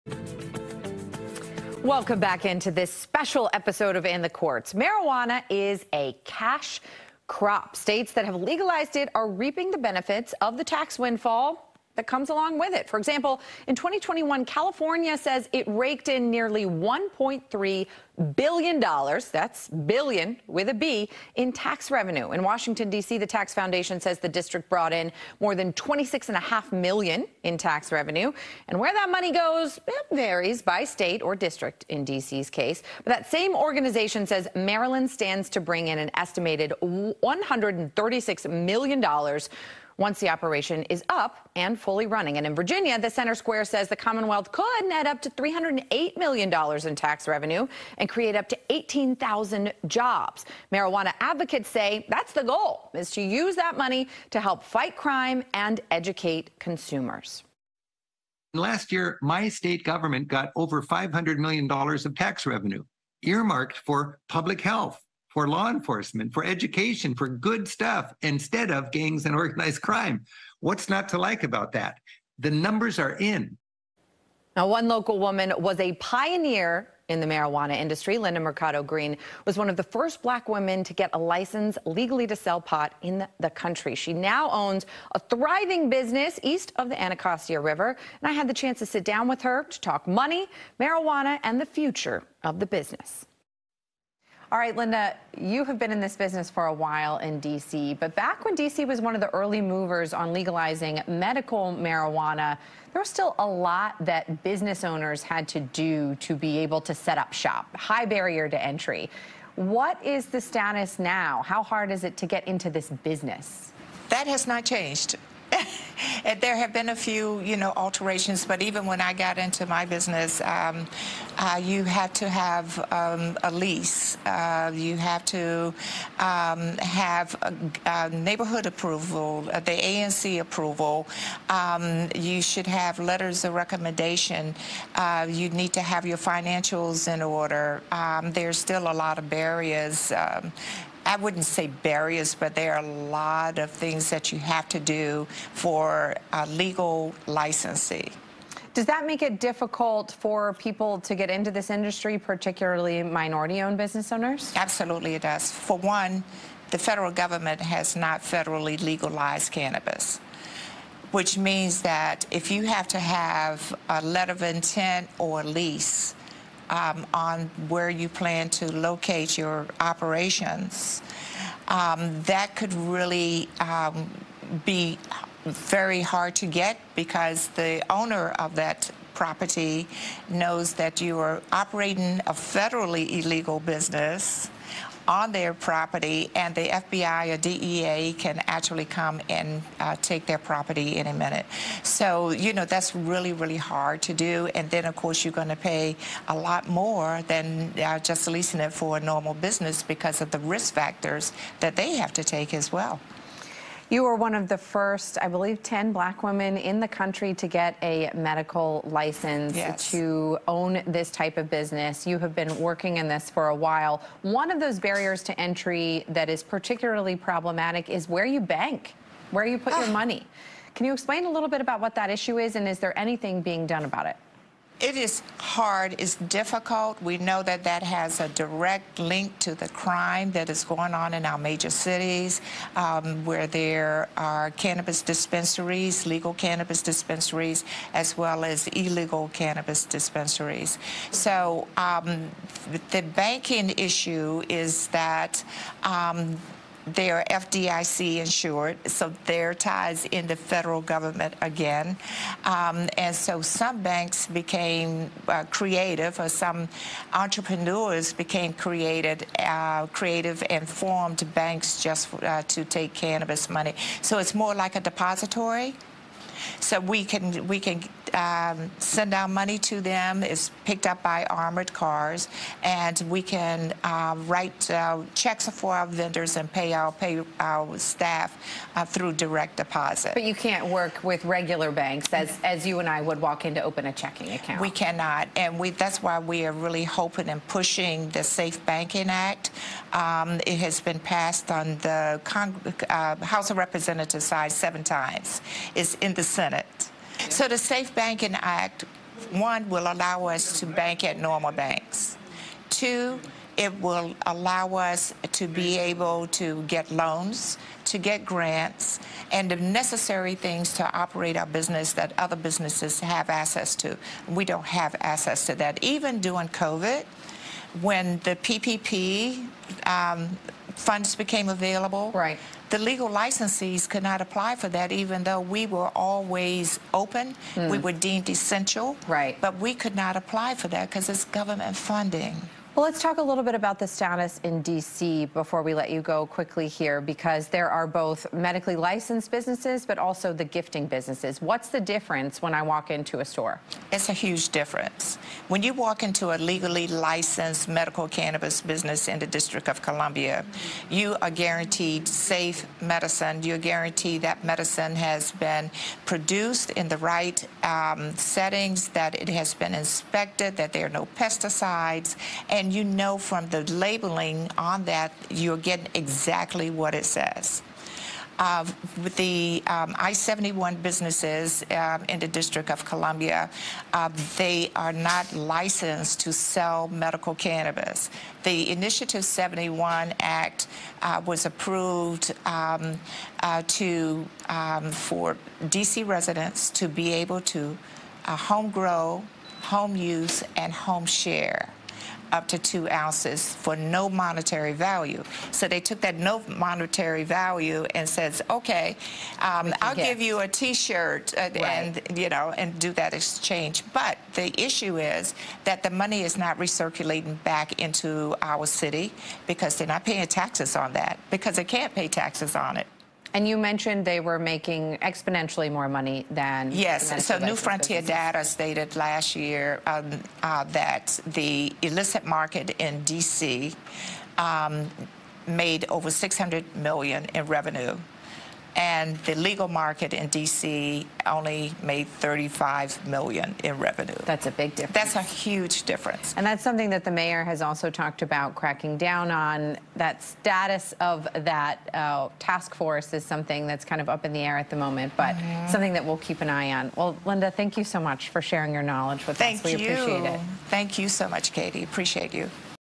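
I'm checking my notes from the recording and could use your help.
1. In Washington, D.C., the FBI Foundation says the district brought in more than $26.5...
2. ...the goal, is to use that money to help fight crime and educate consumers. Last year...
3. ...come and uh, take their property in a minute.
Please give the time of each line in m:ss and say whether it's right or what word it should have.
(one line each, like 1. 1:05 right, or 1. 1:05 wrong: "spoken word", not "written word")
1. 0:22 wrong: "Tax", not "FBI"
2. 0:52 right
3. 3:08 right.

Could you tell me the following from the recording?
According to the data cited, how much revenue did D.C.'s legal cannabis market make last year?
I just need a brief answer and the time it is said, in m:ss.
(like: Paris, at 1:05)
$35 million, at 7:12.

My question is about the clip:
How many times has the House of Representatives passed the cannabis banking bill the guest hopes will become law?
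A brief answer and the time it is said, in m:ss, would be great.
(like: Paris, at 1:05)
7, at 4:54.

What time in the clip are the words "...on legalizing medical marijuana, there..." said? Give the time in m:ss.
1:40.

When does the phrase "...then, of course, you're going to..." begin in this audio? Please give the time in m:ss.
3:14.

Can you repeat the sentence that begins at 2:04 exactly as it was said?
Uh, you have to um, have a, a neighborhood approval, uh, the ANC approval.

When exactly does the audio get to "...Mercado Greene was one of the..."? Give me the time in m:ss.
1:18.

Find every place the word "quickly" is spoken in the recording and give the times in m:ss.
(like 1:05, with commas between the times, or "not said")
5:36.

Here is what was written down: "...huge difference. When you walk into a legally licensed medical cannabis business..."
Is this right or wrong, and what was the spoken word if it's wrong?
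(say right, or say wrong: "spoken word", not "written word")
right.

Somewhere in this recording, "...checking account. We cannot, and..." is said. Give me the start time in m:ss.
4:43.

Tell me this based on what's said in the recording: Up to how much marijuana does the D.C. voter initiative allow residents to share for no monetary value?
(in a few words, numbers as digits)
2 ounces.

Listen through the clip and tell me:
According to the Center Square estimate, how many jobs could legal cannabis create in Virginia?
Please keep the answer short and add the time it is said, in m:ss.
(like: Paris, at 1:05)
18,000, at 0:48.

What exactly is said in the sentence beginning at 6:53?
And you mentioned they were making exponentially more money than...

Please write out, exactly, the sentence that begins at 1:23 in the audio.
She now owns a thriving business east of the Anacostia River.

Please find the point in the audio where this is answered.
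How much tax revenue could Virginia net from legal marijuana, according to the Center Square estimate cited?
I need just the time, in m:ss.
0:45.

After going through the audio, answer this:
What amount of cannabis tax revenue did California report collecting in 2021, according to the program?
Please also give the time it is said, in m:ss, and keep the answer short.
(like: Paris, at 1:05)
nearly $1.3 billion, at 0:16.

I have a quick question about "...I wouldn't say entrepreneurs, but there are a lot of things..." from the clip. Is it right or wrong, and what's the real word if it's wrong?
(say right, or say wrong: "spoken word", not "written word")
wrong: "barriers", not "entrepreneurs".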